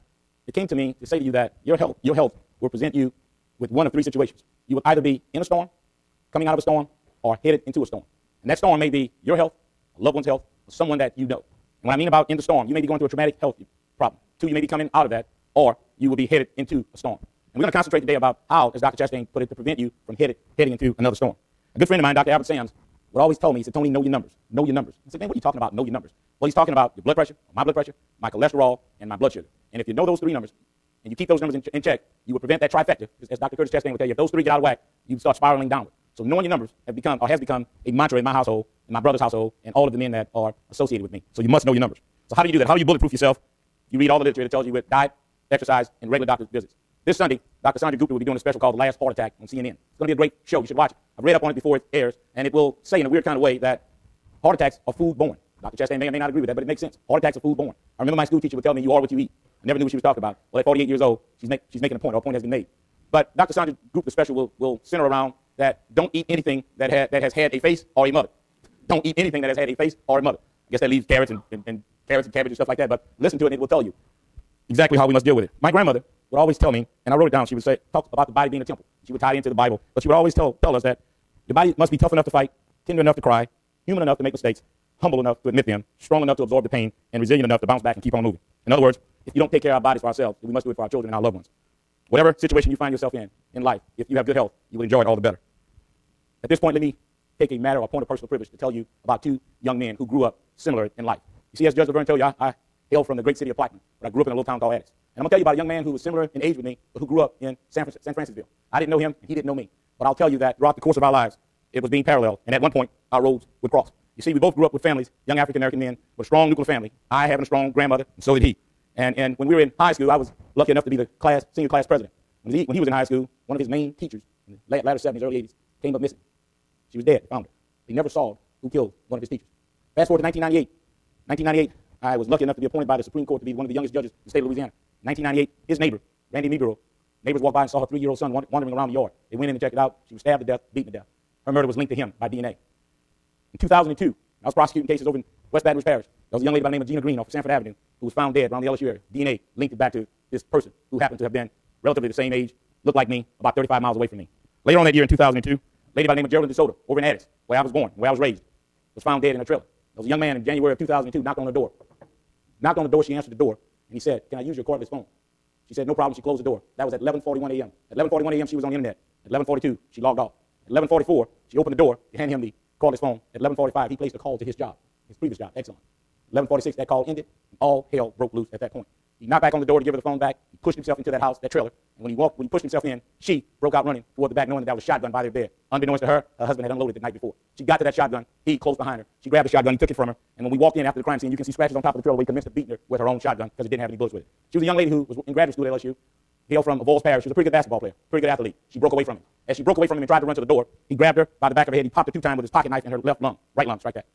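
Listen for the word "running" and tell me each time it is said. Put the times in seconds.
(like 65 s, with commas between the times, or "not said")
183 s.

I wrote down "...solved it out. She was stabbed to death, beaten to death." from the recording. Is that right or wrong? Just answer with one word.
wrong.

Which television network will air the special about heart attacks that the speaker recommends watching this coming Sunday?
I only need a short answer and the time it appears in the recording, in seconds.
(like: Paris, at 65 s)
CNN, at 49 s.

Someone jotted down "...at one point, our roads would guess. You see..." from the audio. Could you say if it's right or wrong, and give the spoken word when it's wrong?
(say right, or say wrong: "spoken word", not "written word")
wrong: "cross", not "guess".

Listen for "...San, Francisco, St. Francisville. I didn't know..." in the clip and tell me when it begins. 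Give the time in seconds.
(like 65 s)
107 s.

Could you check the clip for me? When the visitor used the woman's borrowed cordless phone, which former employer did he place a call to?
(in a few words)
Exxon.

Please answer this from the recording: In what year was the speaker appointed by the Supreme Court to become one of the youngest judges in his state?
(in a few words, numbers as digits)
1998.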